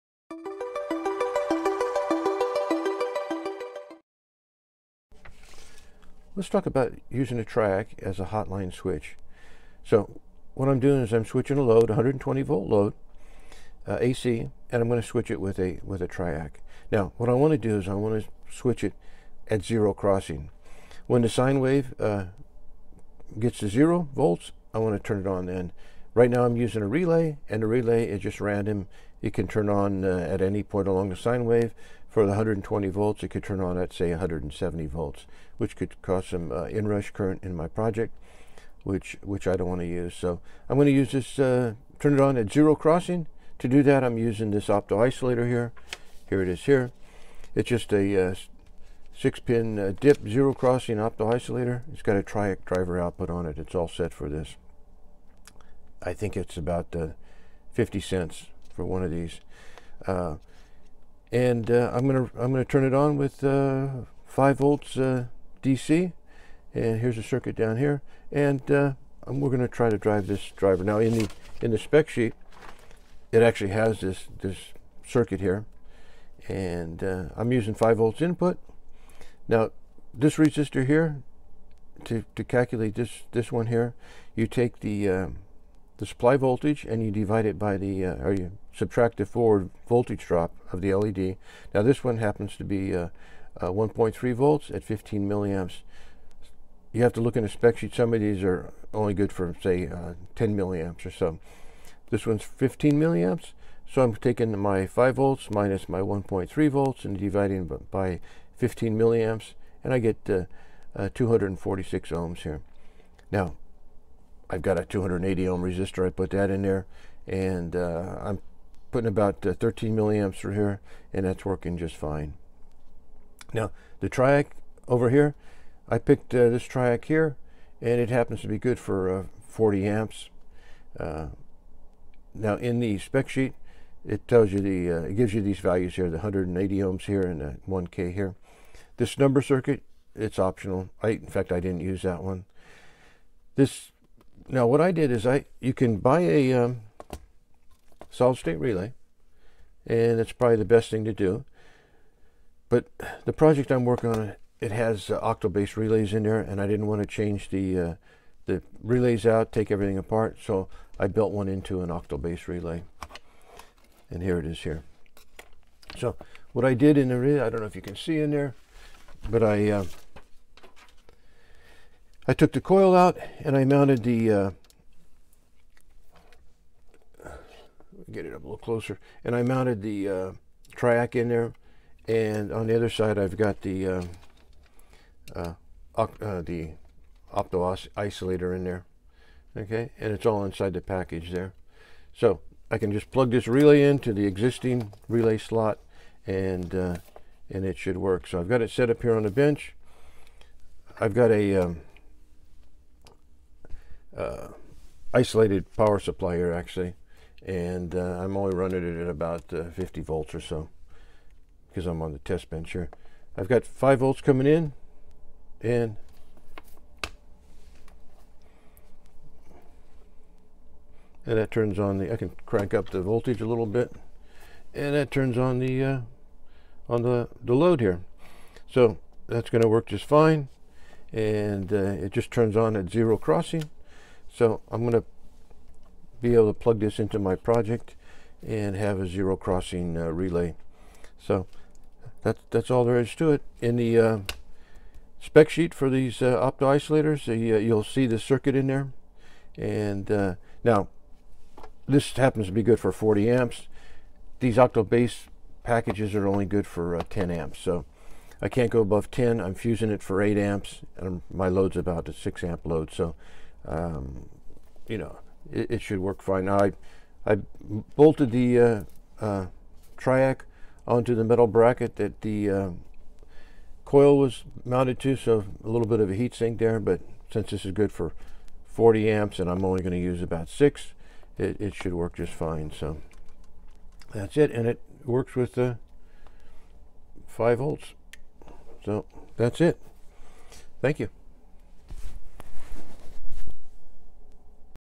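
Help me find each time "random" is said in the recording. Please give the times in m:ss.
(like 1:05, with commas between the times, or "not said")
0:28.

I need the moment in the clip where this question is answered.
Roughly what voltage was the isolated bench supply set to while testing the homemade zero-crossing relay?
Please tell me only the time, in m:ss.
3:29.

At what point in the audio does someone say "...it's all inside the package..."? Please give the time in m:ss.
3:10.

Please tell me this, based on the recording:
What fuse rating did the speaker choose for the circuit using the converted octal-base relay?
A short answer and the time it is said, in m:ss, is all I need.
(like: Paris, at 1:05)
8 amps, at 4:20.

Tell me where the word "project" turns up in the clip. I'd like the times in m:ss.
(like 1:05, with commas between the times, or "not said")
0:37, 2:33, 3:57.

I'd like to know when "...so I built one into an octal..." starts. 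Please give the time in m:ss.
2:40.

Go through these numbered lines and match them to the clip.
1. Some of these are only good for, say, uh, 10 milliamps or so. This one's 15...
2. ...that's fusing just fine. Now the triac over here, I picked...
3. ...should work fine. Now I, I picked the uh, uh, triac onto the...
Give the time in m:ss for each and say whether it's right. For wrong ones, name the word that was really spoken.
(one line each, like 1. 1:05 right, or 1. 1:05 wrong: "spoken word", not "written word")
1. 1:37 right
2. 2:01 wrong: "working", not "fusing"
3. 4:25 wrong: "bolted", not "picked".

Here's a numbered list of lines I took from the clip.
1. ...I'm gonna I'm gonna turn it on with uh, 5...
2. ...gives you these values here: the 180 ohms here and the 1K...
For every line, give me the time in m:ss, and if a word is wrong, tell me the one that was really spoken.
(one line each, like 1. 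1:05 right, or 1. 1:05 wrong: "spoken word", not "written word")
1. 1:01 right
2. 2:15 right.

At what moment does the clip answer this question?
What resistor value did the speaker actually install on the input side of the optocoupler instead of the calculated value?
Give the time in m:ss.
1:54.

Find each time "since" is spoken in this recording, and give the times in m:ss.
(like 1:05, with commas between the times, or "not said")
4:37.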